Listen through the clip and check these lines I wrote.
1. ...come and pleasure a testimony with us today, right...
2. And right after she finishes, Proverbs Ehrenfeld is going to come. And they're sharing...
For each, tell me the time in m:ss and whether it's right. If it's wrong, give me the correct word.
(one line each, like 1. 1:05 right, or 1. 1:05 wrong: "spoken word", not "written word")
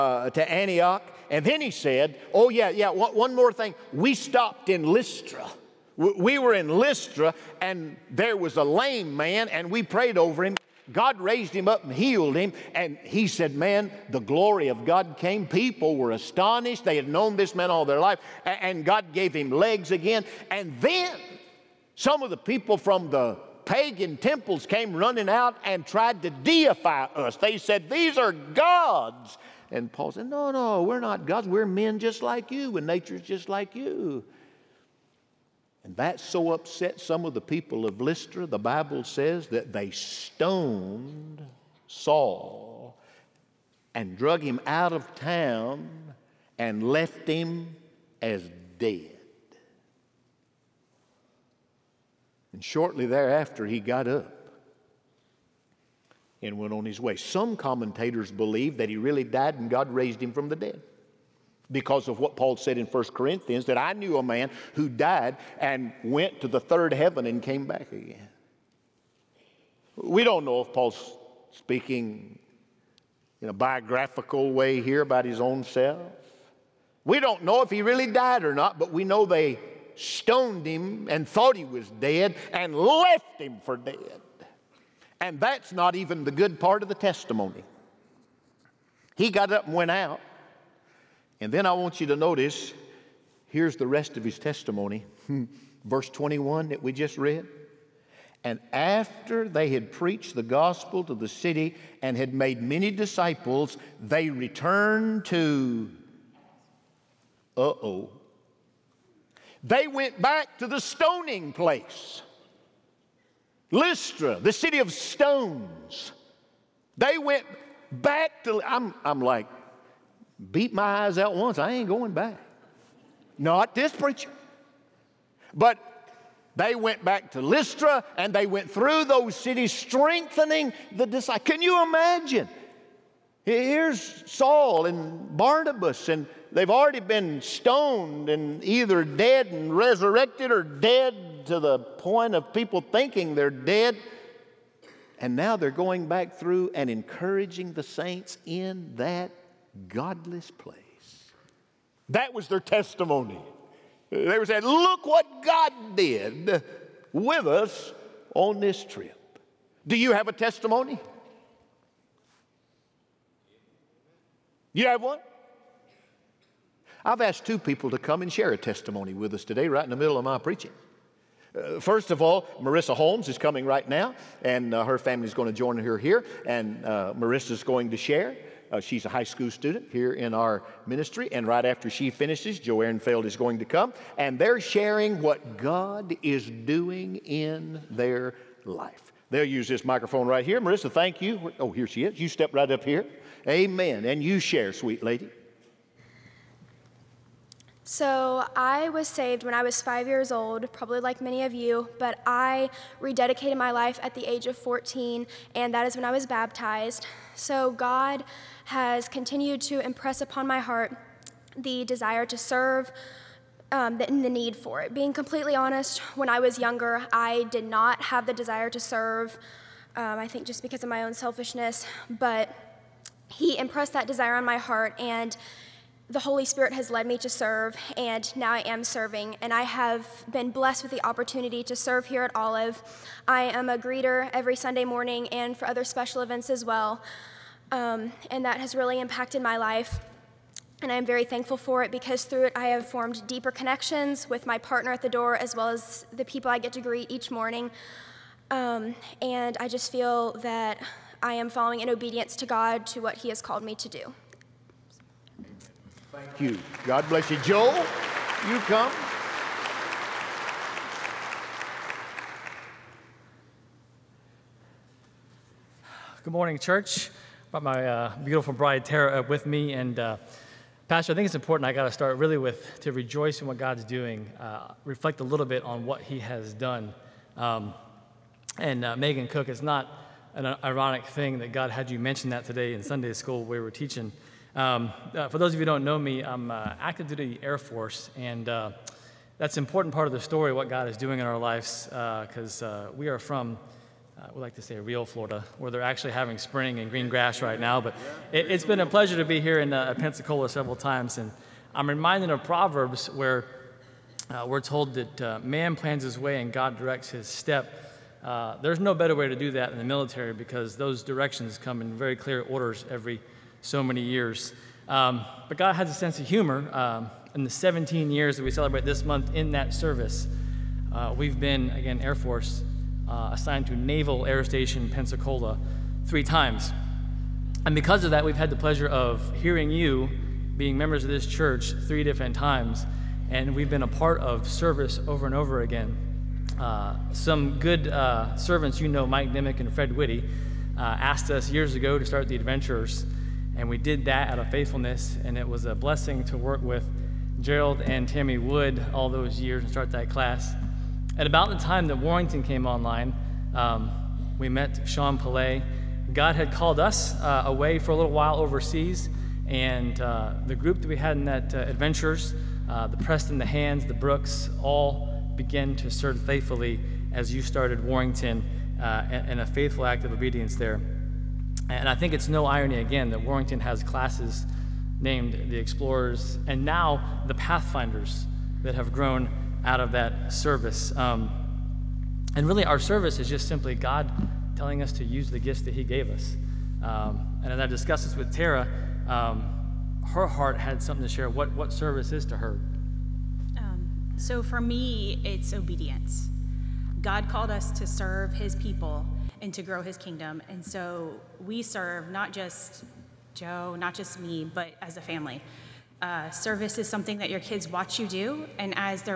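1. 2:47 wrong: "share", not "pleasure"
2. 3:01 wrong: "Joe", not "Proverbs".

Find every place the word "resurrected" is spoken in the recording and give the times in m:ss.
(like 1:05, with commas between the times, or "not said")
2:19.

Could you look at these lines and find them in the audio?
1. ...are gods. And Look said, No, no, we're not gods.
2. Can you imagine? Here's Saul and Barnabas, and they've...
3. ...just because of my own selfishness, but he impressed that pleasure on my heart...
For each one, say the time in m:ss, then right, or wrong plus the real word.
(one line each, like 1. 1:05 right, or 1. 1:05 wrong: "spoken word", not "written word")
1. 0:28 wrong: "Paul", not "Look"
2. 2:11 right
3. 3:40 wrong: "desire", not "pleasure".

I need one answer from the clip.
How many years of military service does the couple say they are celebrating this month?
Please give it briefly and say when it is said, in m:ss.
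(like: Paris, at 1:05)
17, at 5:17.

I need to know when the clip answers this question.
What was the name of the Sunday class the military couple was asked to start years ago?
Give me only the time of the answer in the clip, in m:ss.
5:42.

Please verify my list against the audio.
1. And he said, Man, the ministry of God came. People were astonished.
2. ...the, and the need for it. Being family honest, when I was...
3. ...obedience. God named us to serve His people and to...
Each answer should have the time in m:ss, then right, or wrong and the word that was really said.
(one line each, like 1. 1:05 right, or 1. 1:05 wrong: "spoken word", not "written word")
1. 0:12 wrong: "glory", not "ministry"
2. 3:33 wrong: "completely", not "family"
3. 6:35 wrong: "called", not "named".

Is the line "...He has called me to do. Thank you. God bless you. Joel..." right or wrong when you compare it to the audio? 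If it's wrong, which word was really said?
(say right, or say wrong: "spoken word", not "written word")
right.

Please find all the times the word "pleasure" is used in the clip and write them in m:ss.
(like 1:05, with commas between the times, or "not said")
4:58, 5:28.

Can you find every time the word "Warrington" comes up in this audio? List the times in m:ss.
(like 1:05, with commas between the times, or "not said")
5:51, 6:07, 6:13.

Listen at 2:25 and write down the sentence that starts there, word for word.
And now they're going back through and encouraging the saints in that godless place.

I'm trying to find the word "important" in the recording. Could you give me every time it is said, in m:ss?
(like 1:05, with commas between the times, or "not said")
4:31, 4:49.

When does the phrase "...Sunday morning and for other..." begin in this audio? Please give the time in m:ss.
3:54.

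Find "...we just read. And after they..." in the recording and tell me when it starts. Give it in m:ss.
1:36.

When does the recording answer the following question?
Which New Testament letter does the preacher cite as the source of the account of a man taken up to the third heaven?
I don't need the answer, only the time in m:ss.
1:02.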